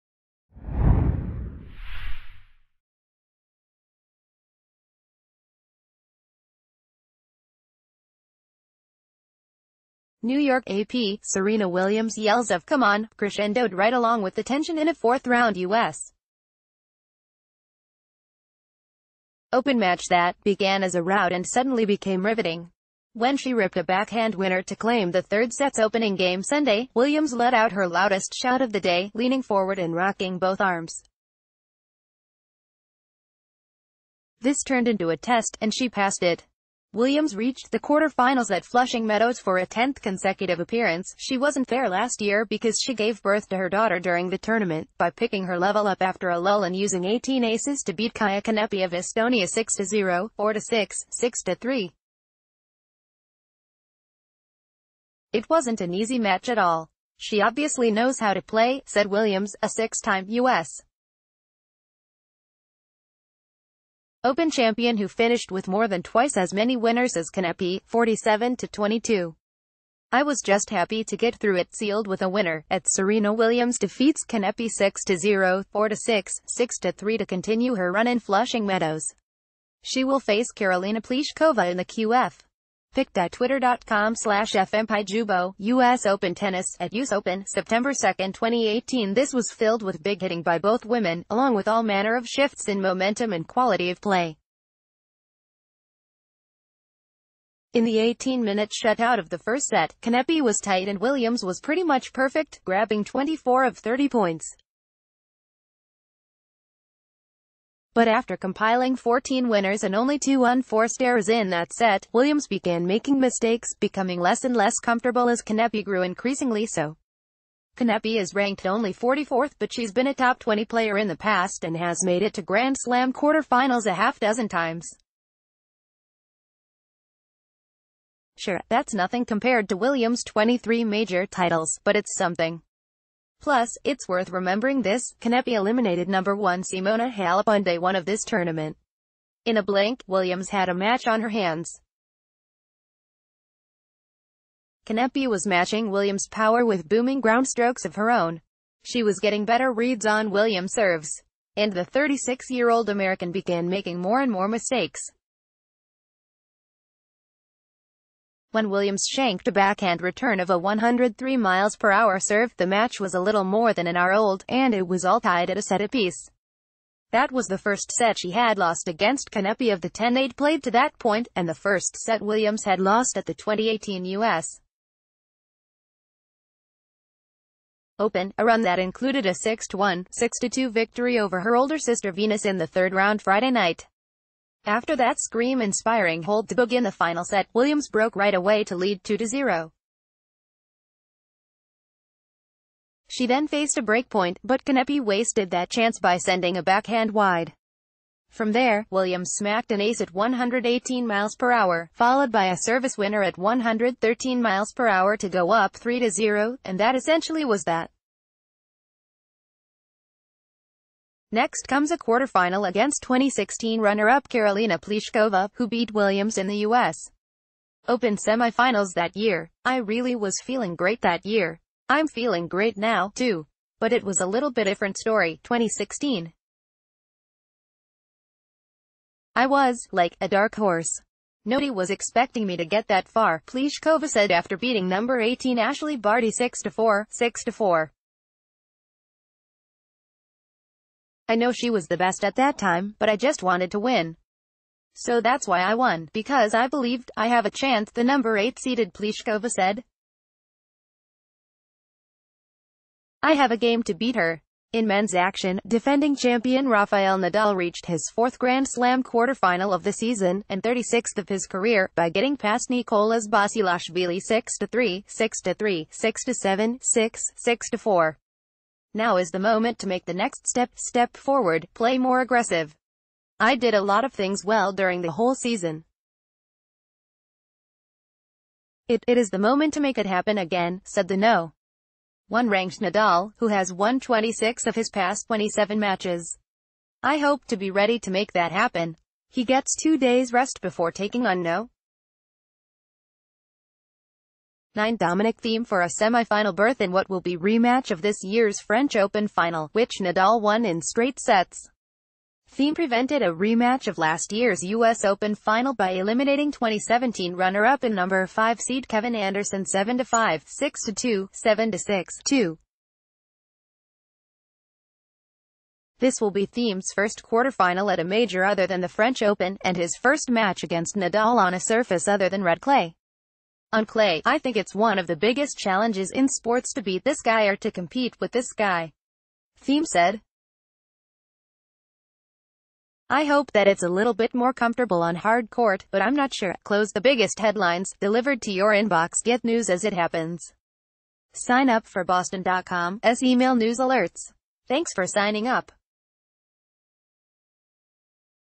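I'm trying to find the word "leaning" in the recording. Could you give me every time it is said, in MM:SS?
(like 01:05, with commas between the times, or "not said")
00:29.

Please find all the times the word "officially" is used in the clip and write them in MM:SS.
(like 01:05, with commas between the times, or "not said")
not said.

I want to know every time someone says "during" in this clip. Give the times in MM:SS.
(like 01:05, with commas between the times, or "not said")
00:44, 04:34.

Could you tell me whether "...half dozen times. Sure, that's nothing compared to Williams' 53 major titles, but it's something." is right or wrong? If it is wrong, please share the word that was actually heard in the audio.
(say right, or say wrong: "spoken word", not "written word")
wrong: "23", not "53".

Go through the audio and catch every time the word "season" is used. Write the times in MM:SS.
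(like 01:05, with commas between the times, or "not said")
04:19, 04:35.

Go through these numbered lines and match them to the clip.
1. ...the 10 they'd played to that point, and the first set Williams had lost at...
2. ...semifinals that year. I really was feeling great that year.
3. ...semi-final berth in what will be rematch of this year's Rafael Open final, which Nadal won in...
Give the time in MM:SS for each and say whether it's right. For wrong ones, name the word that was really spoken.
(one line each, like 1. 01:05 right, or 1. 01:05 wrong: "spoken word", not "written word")
1. 02:49 right
2. 03:38 right
3. 04:55 wrong: "French", not "Rafael".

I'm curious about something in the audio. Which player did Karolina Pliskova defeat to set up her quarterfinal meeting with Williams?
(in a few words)
Ashleigh Barty.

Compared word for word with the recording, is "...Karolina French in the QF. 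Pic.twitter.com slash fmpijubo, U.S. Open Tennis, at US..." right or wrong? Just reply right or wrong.
wrong.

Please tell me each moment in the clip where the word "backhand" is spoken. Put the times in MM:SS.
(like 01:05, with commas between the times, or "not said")
00:23, 02:39, 03:16.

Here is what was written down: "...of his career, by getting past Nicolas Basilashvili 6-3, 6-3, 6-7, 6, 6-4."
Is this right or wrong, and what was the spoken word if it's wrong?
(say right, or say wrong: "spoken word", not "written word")
right.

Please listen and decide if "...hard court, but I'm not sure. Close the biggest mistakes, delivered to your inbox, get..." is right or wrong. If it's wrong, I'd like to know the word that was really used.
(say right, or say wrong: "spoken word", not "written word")
wrong: "headlines", not "mistakes".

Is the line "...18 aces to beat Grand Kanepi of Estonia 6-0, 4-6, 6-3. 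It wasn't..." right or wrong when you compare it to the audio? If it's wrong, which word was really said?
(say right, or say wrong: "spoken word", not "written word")
wrong: "Kaya", not "Grand".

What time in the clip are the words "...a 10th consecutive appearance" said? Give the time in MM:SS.
00:39.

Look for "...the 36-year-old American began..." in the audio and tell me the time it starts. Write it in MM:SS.
02:31.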